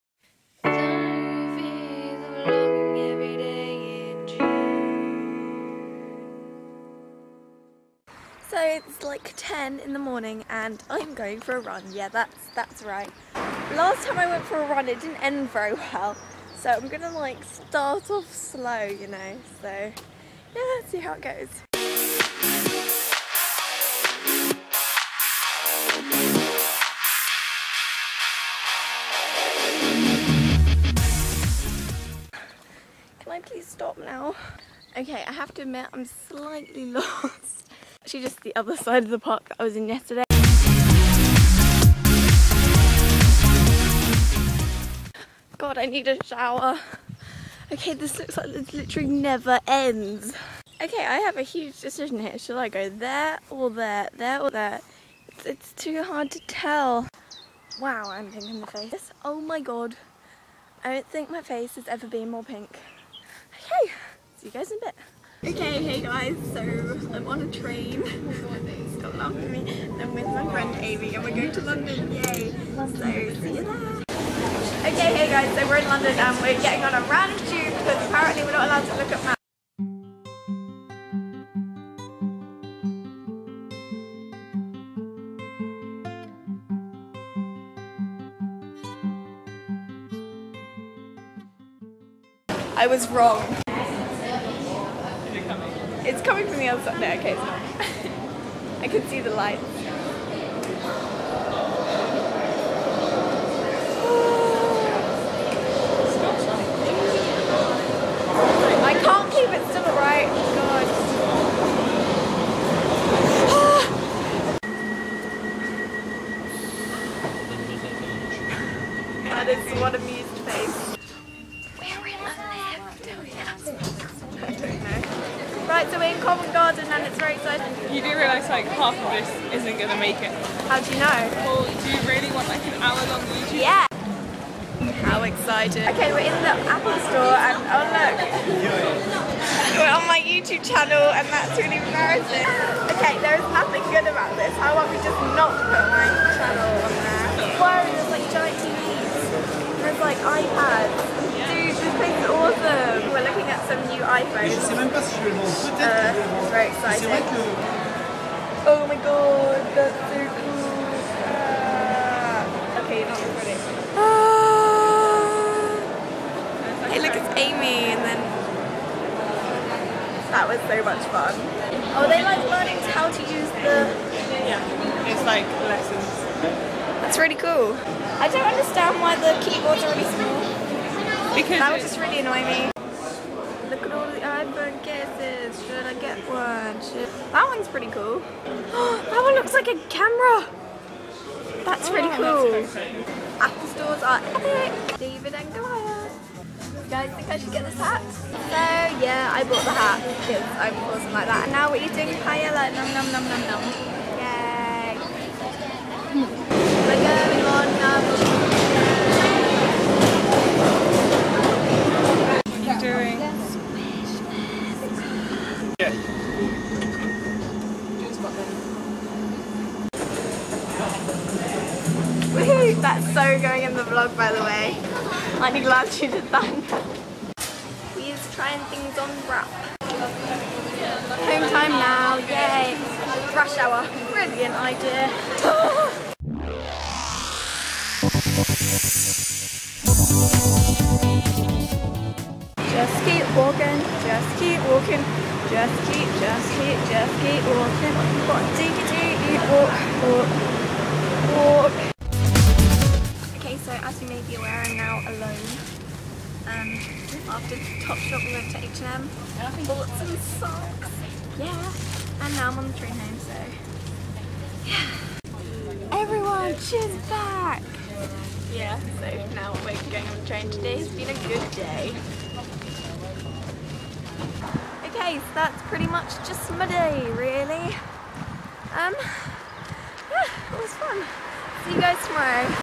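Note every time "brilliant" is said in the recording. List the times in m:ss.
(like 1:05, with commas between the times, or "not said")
3:54.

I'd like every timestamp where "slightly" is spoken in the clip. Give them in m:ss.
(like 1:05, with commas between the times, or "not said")
0:36.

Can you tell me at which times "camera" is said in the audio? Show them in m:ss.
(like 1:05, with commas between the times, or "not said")
3:09.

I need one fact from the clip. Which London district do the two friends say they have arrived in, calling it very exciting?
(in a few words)
Covent Garden.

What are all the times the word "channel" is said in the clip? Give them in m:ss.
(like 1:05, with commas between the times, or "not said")
2:20, 2:26.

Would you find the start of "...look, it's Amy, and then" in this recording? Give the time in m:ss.
2:46.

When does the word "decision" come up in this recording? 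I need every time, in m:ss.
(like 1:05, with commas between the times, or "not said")
0:51.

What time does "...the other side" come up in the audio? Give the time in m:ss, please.
1:36.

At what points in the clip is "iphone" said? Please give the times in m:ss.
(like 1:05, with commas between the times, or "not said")
2:34, 3:04.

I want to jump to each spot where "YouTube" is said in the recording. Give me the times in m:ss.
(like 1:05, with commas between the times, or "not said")
2:13, 2:20.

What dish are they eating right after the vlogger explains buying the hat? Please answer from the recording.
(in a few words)
Paella.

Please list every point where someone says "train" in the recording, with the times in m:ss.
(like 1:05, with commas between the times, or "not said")
1:07, 4:22, 4:30.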